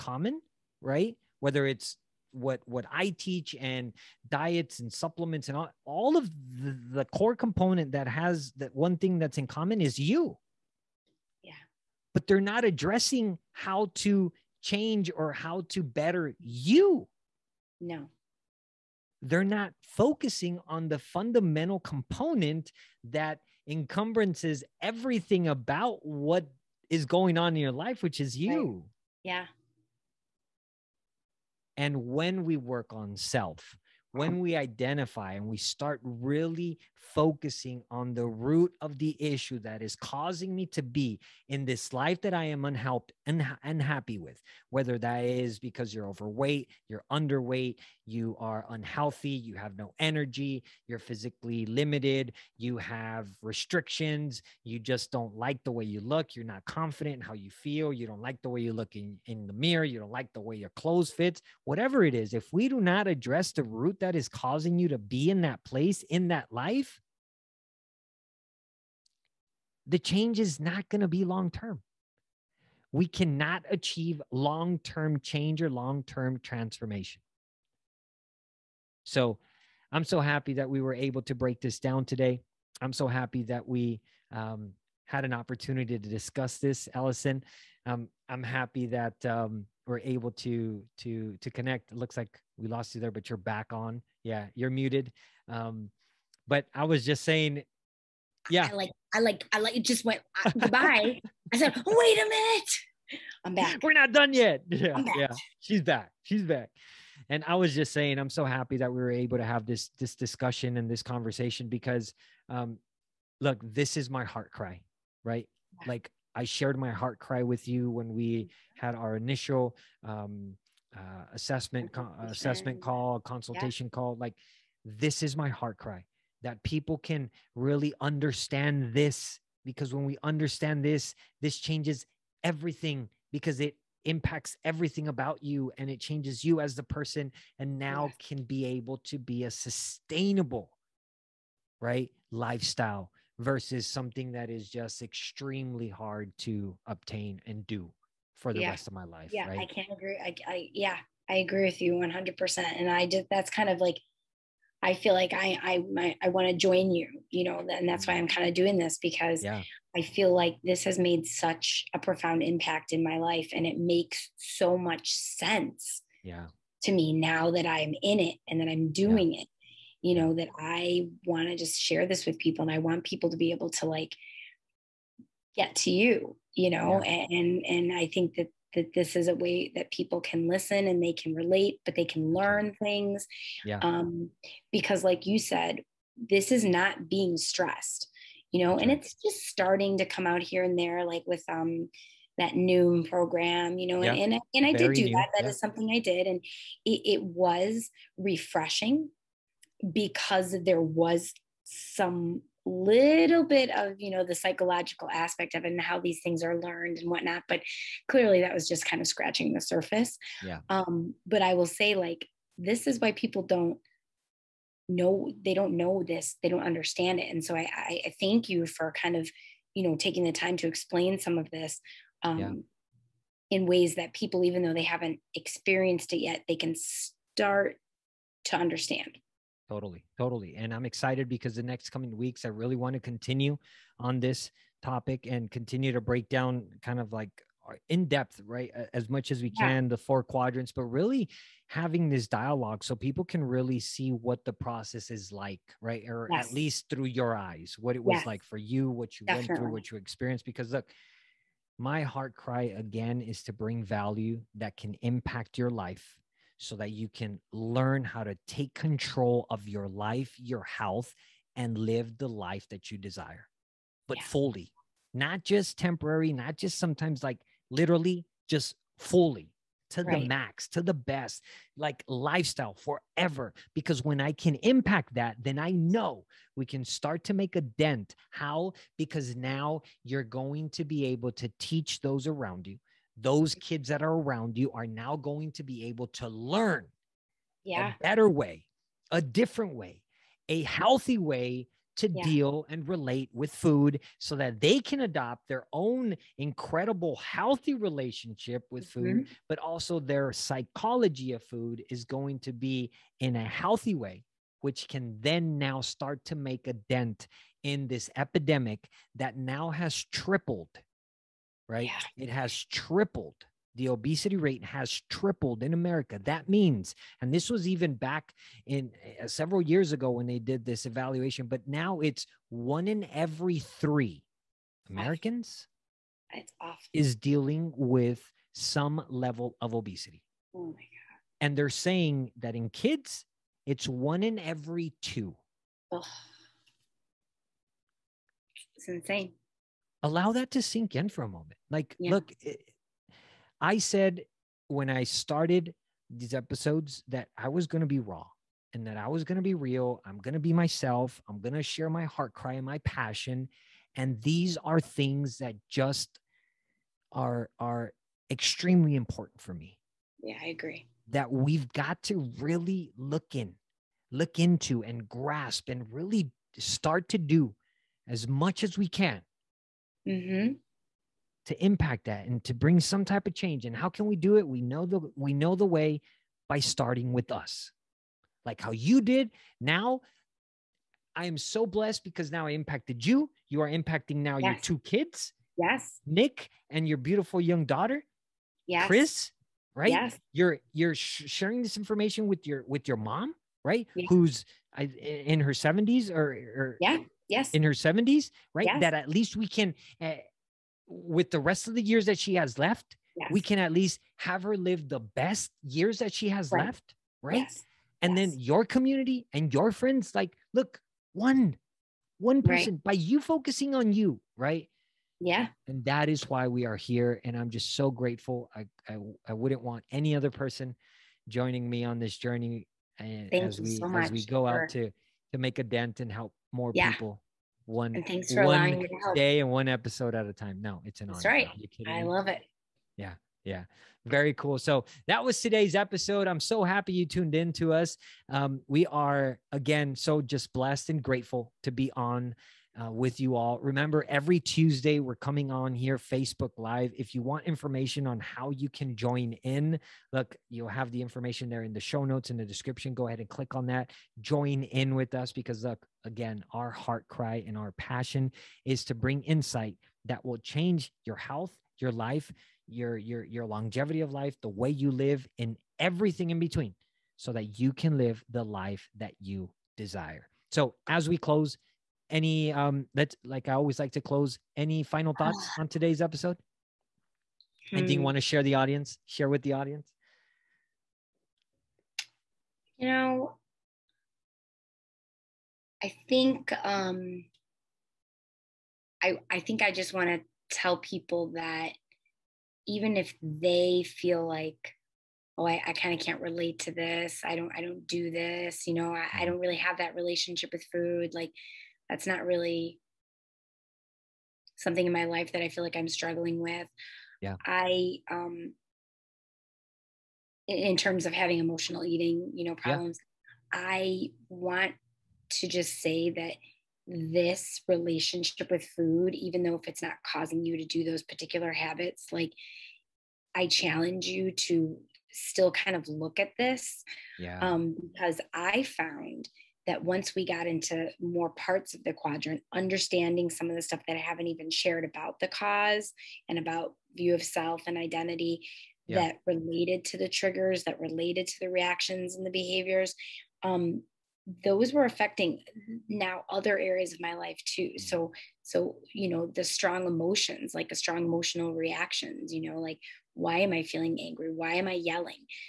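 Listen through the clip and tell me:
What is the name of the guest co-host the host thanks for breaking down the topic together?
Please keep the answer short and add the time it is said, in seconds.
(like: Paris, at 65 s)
Allison, at 86 s.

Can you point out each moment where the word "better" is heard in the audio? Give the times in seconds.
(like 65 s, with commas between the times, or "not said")
15 s, 288 s.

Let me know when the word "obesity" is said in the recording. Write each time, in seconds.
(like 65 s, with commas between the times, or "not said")
313 s, 329 s.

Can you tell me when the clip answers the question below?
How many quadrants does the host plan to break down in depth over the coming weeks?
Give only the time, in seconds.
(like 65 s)
239 s.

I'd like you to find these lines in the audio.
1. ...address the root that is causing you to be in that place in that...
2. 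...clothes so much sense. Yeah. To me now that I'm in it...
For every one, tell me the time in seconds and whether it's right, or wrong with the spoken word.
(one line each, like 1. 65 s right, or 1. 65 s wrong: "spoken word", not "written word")
1. 63 s right
2. 163 s wrong: "makes", not "clothes".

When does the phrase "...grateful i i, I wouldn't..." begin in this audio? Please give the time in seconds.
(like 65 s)
417 s.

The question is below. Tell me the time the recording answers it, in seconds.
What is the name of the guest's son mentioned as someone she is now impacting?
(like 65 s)
386 s.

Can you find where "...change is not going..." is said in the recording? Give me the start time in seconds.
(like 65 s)
69 s.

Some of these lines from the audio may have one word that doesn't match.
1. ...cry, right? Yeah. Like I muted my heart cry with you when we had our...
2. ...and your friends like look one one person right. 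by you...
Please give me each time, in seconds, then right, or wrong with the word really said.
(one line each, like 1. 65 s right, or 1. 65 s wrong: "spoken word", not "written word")
1. 114 s wrong: "shared", not "muted"
2. 409 s right.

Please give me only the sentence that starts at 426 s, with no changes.
people one and thanks for one allowing me to help.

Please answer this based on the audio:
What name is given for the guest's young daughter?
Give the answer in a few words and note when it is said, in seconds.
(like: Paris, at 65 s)
Chris, at 388 s.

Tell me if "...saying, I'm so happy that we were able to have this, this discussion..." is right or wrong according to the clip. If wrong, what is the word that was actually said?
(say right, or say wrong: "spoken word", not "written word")
right.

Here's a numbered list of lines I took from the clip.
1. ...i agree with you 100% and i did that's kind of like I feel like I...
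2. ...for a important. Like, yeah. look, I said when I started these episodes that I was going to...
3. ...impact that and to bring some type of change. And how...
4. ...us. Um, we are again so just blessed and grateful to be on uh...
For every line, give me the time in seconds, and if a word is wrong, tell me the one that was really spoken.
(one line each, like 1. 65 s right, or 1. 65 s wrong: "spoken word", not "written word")
1. 151 s right
2. 341 s wrong: "moment", not "important"
3. 371 s right
4. 437 s right.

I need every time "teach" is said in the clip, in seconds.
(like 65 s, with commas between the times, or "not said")
3 s, 281 s.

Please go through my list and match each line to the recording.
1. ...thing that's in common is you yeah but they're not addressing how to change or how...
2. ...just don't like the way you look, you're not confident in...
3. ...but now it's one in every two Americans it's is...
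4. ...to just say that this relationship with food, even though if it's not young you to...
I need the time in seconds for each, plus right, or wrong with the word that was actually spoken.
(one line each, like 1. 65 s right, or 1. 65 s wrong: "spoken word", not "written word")
1. 8 s right
2. 54 s right
3. 321 s wrong: "three", not "two"
4. 515 s wrong: "causing", not "young".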